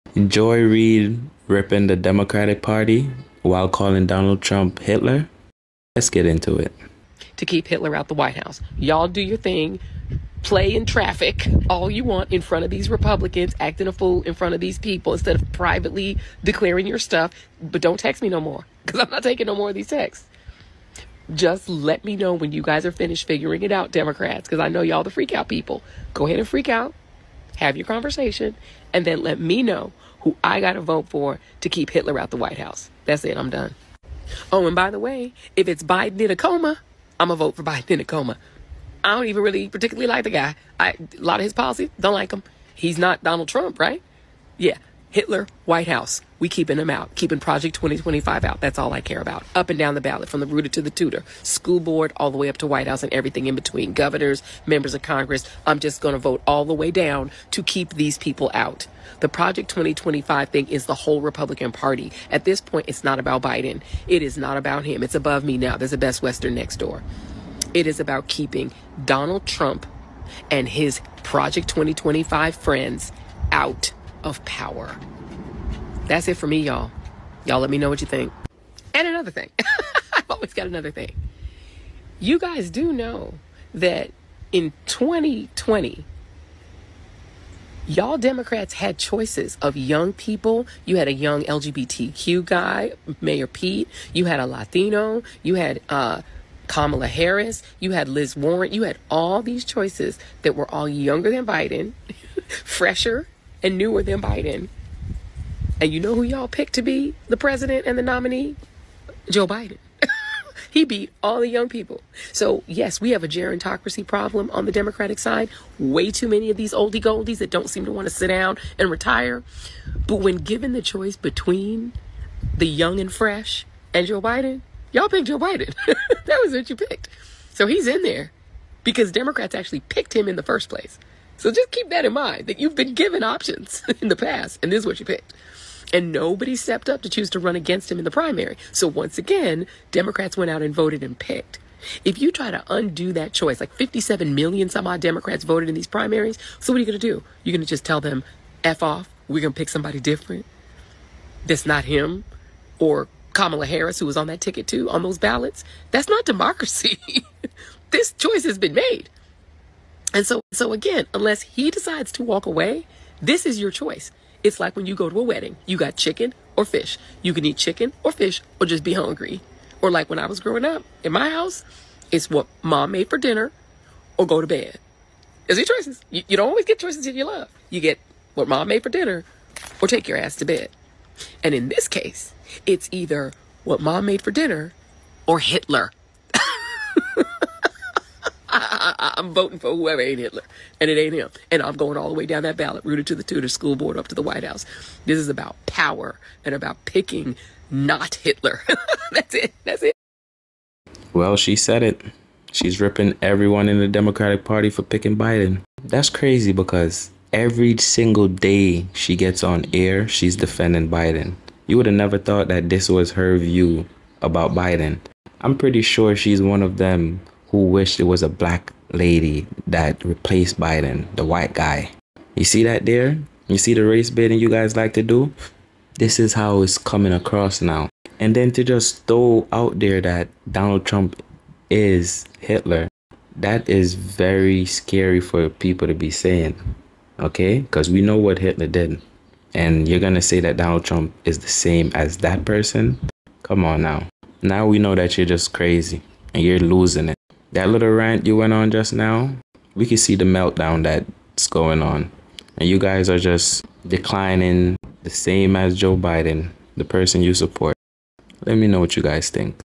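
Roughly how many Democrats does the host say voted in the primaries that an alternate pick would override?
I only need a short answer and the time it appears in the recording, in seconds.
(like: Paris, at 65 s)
57 million, at 143 s.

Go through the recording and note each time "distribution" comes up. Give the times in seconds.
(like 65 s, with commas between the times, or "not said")
not said.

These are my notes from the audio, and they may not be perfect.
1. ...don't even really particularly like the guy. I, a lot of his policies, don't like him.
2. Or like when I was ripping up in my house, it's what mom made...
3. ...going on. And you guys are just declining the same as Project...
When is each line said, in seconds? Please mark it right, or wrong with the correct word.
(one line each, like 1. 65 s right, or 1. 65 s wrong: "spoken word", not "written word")
1. 39 s right
2. 169 s wrong: "growing", not "ripping"
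3. 251 s wrong: "Joe", not "Project".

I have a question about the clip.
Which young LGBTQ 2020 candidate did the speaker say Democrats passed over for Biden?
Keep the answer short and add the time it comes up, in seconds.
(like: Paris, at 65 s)
Mayor Pete, at 93 s.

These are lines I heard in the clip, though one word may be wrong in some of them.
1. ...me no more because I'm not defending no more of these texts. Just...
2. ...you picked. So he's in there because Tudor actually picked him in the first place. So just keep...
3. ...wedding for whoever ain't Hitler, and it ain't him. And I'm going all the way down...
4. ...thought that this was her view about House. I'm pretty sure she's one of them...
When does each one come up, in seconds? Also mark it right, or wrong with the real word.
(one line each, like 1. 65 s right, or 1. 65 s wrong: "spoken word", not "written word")
1. 18 s wrong: "taking", not "defending"
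2. 126 s wrong: "Democrats", not "Tudor"
3. 189 s wrong: "voting", not "wedding"
4. 212 s wrong: "Biden", not "House".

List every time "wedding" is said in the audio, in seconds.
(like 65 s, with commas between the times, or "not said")
165 s.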